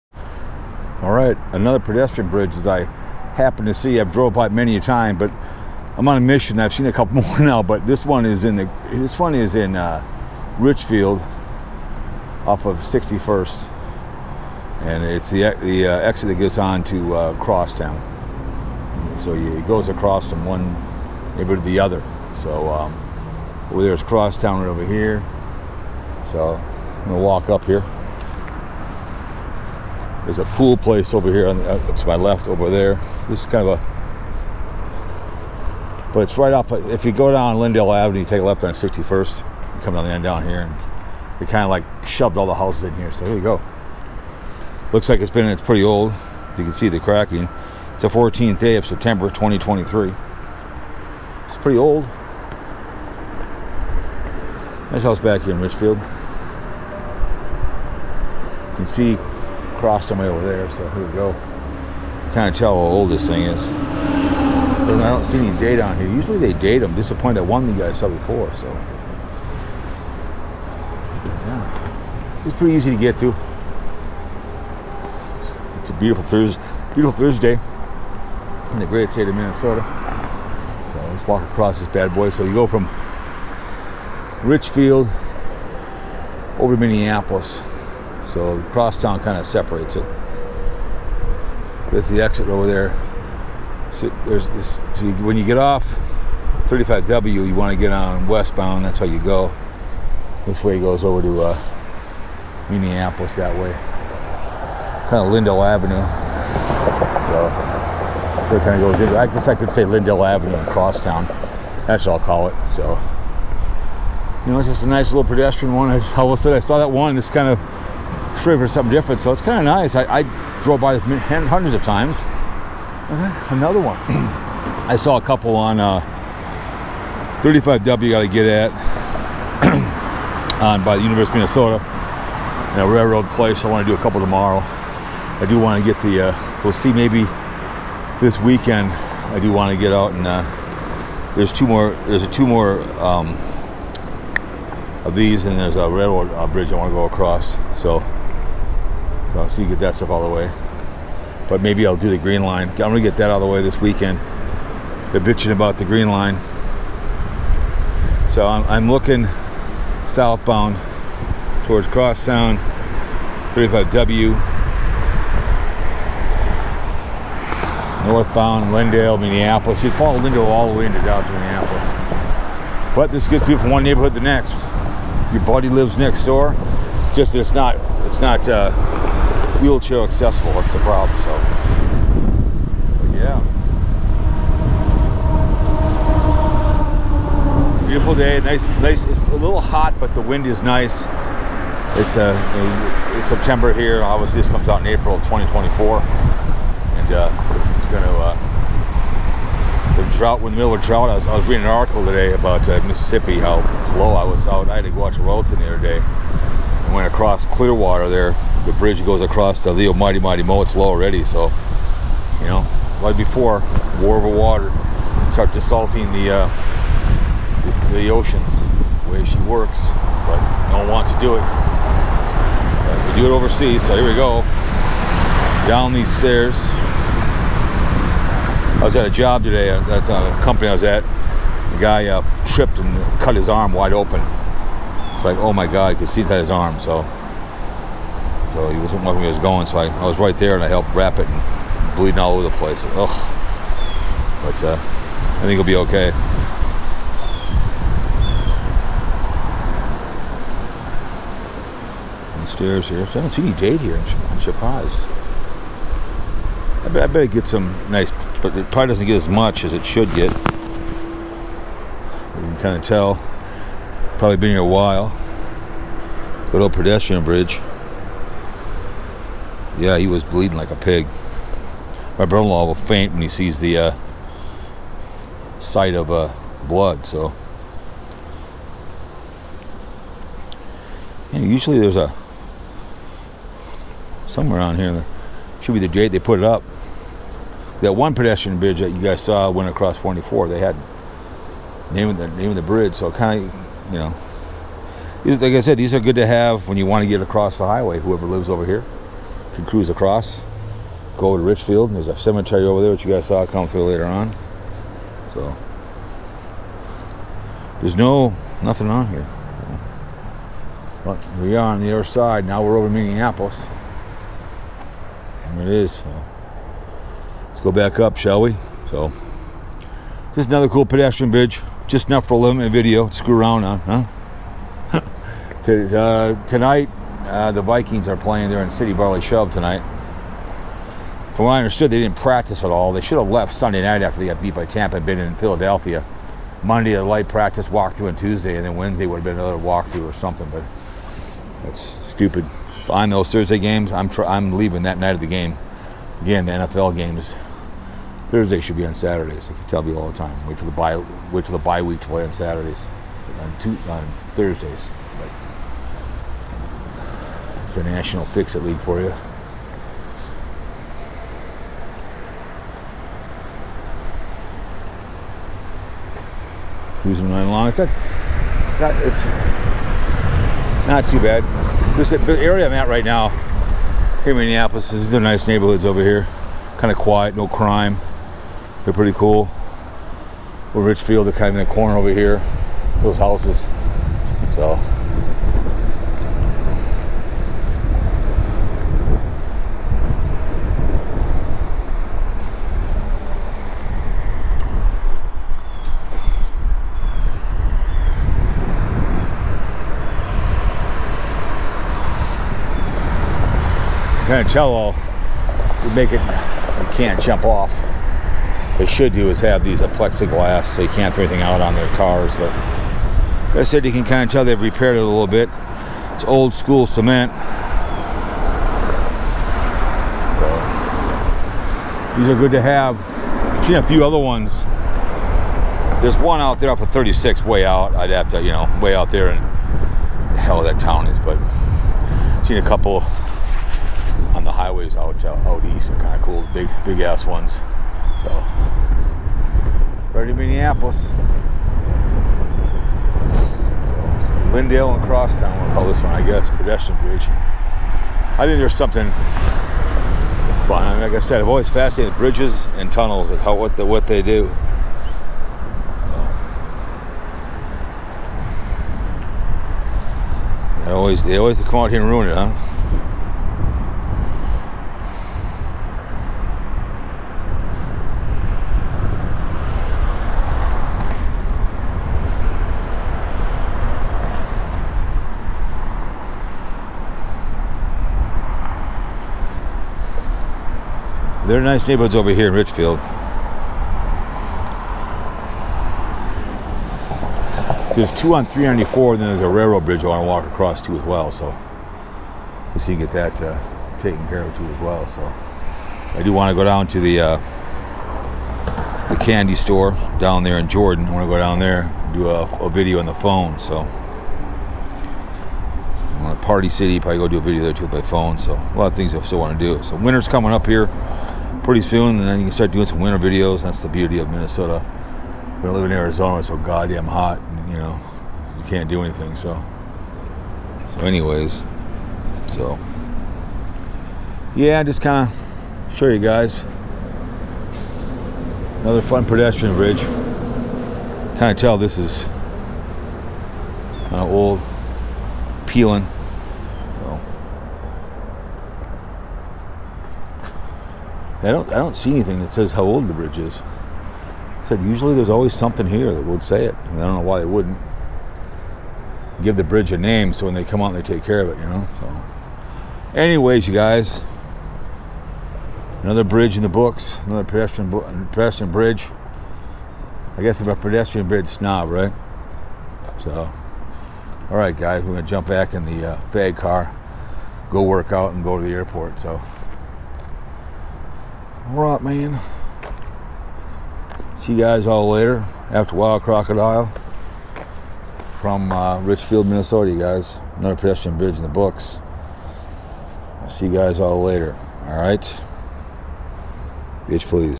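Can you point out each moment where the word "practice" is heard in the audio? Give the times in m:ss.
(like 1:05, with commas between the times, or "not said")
5:32, 5:37.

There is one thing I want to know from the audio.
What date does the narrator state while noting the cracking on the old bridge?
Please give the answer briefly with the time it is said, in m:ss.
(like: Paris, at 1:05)
September 14, 2023, at 0:48.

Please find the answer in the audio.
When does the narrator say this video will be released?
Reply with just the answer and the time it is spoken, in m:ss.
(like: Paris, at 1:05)
April 2024, at 3:14.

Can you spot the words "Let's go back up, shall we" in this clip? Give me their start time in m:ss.
5:17.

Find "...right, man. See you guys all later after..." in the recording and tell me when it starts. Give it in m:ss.
9:31.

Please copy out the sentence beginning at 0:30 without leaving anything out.
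There's a pool place over here on the, uh, to my left over there.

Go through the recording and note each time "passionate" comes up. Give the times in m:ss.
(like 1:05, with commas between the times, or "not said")
not said.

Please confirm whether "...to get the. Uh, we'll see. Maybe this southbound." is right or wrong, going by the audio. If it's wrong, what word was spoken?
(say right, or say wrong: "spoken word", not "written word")
wrong: "weekend", not "southbound".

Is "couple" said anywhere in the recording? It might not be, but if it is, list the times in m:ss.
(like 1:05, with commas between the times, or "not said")
0:06, 2:05, 2:14, 7:12.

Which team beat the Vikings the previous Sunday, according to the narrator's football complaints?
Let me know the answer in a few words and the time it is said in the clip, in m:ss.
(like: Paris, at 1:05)
Tampa, at 5:34.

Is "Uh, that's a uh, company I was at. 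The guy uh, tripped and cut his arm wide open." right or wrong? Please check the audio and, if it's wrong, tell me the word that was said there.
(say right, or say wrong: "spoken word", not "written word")
right.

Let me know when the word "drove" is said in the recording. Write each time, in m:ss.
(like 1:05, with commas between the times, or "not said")
0:04, 2:00.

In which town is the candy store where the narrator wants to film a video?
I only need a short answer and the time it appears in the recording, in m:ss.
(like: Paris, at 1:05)
Jordan, at 8:20.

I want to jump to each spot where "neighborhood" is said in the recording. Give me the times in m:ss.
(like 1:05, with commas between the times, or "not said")
0:21, 2:53, 6:15, 8:01.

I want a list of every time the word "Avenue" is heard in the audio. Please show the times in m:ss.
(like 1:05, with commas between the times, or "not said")
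0:37, 1:45, 1:50.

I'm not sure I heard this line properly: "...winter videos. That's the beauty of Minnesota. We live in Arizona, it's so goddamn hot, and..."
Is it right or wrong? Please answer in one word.
right.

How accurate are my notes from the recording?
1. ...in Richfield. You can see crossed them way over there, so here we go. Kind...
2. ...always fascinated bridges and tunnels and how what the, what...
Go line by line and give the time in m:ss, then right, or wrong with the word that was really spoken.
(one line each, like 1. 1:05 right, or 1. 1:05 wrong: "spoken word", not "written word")
1. 0:55 right
2. 7:31 right.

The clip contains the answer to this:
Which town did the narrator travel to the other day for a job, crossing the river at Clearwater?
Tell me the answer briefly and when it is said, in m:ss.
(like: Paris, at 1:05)
Royalton, at 3:25.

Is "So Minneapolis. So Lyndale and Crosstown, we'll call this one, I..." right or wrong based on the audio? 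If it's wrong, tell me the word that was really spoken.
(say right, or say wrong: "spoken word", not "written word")
right.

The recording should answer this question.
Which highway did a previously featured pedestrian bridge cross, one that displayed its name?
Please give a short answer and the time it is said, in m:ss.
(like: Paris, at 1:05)
44, at 4:49.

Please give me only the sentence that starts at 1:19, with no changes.
So let's walk across this bad boy.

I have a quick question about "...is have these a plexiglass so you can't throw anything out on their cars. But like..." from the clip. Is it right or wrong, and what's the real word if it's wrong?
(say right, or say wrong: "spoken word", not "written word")
right.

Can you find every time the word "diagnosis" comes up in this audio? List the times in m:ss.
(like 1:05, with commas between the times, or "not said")
not said.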